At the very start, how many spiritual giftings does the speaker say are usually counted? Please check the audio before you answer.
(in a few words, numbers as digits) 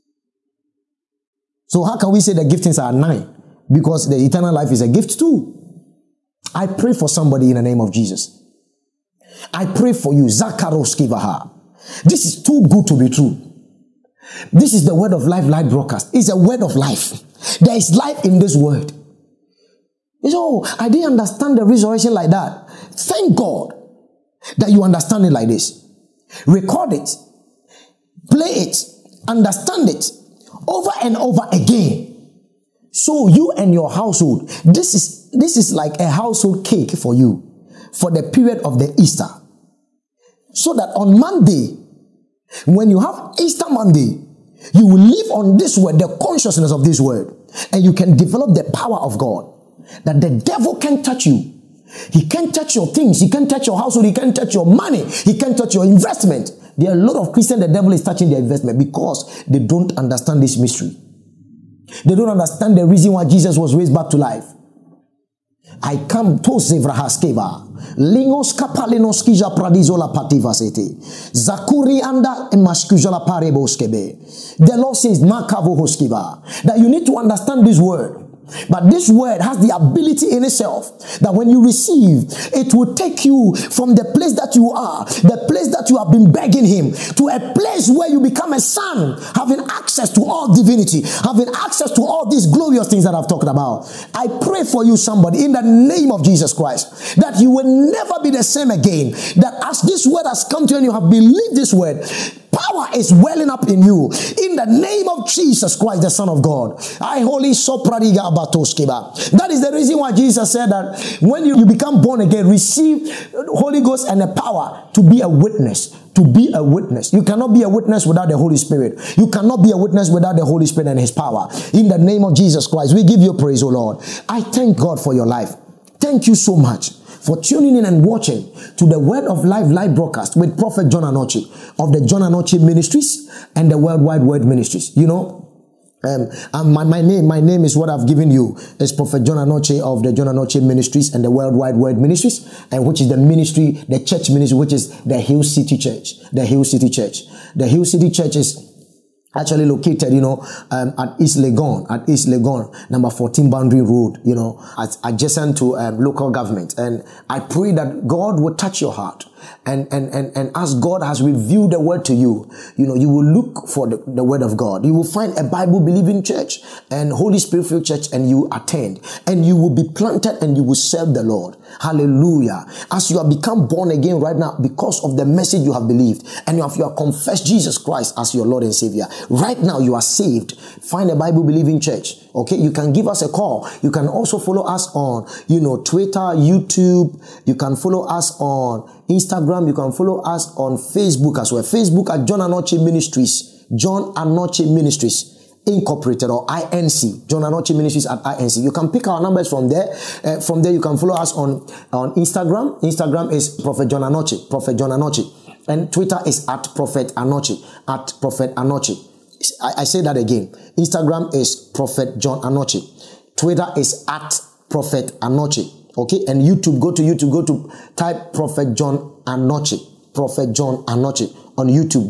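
9.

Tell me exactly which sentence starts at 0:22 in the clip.
Thank God that you understand it like this.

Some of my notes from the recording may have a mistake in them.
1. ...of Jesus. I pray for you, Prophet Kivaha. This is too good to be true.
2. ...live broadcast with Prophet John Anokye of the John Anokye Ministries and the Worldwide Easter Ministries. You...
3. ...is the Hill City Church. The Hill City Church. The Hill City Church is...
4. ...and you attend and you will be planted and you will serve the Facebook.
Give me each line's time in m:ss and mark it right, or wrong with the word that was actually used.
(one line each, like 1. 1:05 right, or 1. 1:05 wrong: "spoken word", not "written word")
1. 0:07 wrong: "Zakaros", not "Prophet"
2. 2:09 wrong: "Word", not "Easter"
3. 2:24 right
4. 2:48 wrong: "Lord", not "Facebook".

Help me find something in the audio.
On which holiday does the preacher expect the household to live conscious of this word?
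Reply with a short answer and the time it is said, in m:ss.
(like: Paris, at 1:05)
Easter Monday, at 0:43.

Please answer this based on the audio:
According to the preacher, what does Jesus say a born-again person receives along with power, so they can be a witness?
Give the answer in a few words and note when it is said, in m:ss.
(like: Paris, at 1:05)
Holy Ghost, at 1:53.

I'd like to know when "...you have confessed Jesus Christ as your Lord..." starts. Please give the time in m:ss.
2:56.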